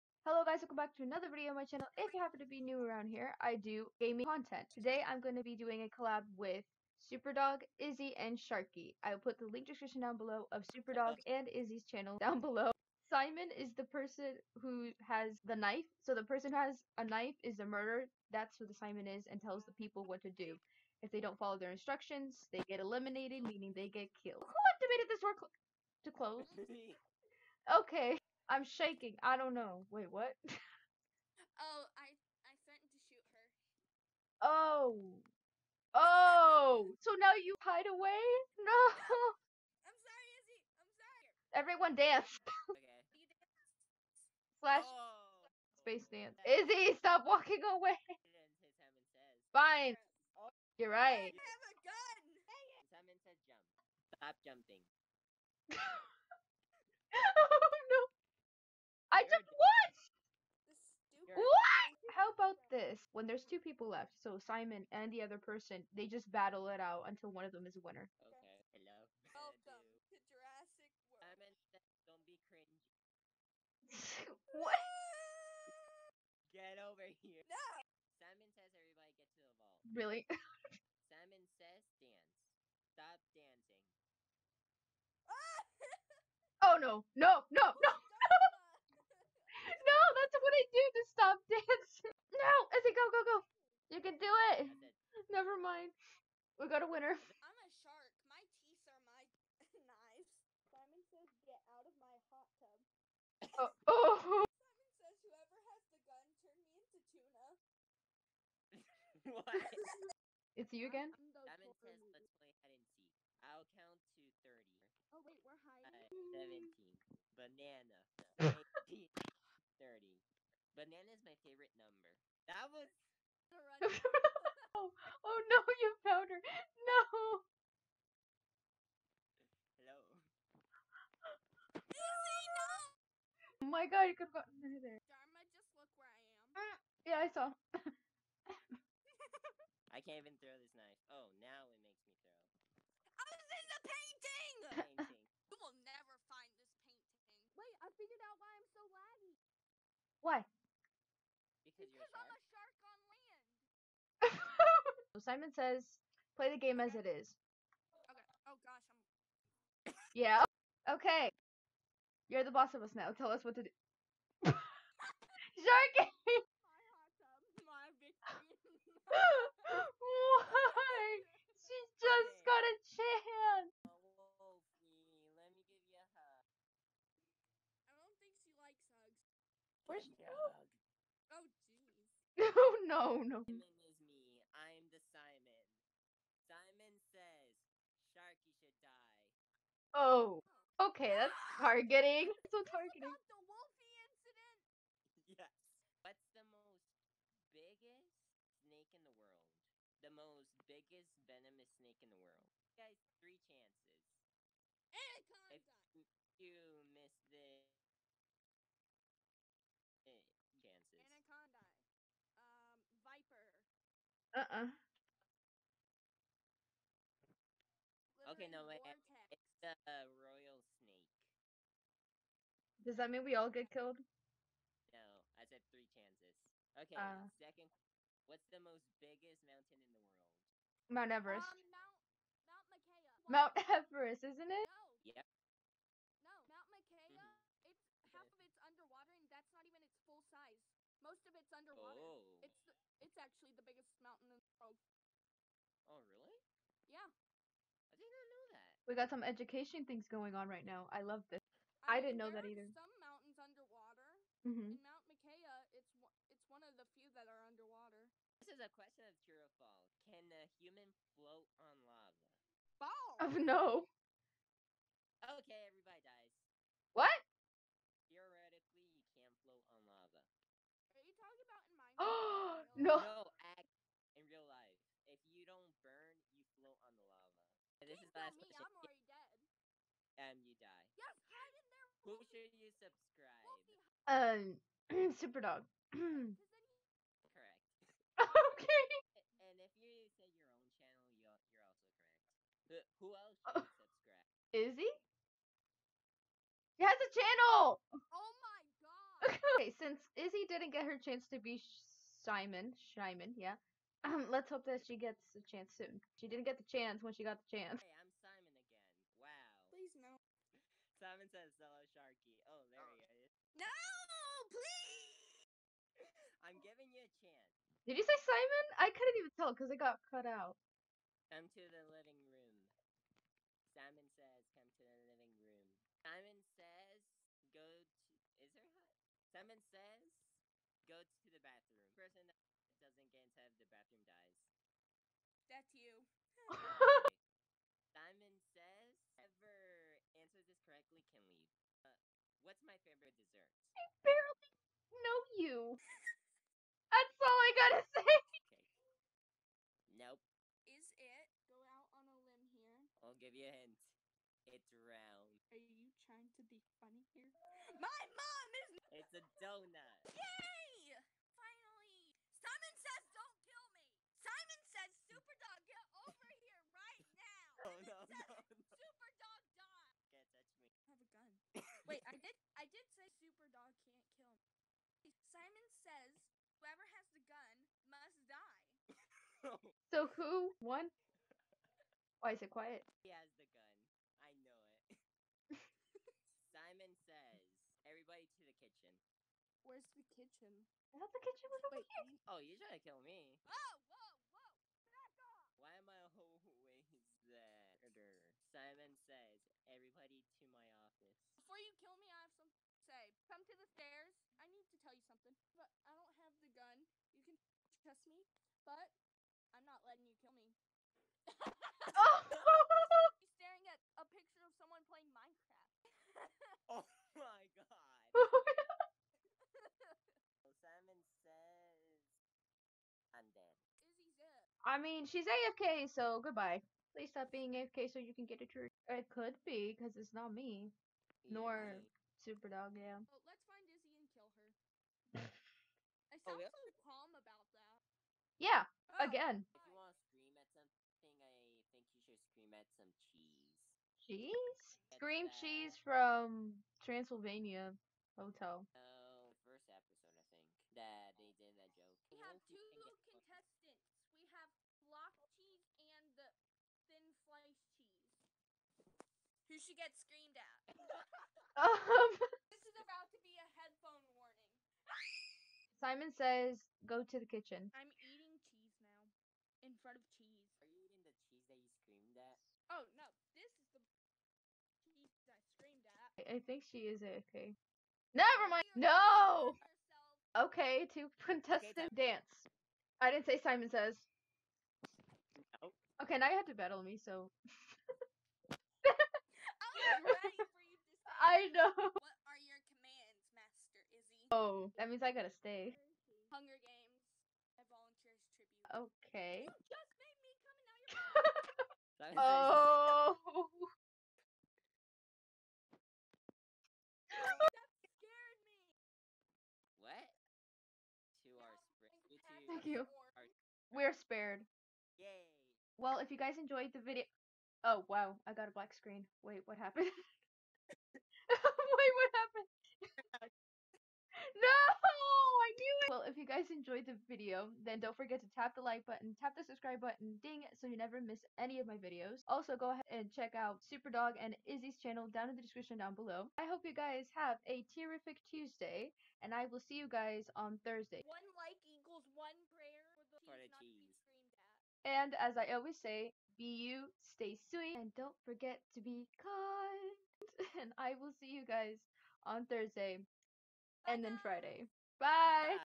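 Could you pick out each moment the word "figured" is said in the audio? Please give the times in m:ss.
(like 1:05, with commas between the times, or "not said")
2:27.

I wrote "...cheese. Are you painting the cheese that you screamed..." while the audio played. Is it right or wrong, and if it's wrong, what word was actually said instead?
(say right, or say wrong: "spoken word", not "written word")
wrong: "eating", not "painting".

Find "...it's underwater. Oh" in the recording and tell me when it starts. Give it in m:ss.
4:01.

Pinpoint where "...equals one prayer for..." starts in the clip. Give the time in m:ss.
9:01.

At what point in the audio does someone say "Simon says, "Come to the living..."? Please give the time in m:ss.
5:23.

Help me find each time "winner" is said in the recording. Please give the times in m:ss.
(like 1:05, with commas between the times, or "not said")
1:07, 1:36.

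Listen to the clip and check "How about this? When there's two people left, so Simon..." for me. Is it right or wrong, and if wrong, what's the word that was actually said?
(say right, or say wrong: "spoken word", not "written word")
right.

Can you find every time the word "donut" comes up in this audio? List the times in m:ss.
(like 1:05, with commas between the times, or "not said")
5:59.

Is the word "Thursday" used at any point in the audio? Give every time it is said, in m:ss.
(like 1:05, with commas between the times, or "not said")
9:00, 9:12.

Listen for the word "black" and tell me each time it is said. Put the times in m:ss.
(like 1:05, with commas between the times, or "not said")
8:38.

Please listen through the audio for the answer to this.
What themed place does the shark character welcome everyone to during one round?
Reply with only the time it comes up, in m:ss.
1:09.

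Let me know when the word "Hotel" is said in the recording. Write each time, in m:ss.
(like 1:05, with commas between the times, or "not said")
7:28.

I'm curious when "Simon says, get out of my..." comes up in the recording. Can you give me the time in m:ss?
1:40.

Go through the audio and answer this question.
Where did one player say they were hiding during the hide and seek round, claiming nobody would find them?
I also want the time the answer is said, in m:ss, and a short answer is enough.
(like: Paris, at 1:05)
the painting, at 2:23.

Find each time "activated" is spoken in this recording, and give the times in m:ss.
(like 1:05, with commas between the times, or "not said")
0:24.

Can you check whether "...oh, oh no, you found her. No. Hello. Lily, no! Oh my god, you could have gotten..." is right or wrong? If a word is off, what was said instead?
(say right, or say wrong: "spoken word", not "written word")
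right.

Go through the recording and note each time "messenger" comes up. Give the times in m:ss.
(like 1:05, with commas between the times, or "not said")
not said.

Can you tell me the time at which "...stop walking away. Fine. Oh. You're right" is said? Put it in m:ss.
0:47.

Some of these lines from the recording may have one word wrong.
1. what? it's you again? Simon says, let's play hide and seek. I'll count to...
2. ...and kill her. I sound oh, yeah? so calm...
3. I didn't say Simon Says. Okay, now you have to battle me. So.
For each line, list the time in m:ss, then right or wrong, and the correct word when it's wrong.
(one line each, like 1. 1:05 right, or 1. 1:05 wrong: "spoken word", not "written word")
1. 1:49 right
2. 7:13 right
3. 8:03 right.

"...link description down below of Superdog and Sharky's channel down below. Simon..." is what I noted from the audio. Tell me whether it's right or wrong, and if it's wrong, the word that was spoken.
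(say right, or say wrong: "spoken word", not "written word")
wrong: "Izzy", not "Sharky".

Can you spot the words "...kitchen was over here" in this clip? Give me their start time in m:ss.
6:31.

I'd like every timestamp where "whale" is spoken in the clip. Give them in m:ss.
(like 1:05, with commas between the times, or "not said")
not said.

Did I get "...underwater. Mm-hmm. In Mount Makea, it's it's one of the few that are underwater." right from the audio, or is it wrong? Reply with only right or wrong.
right.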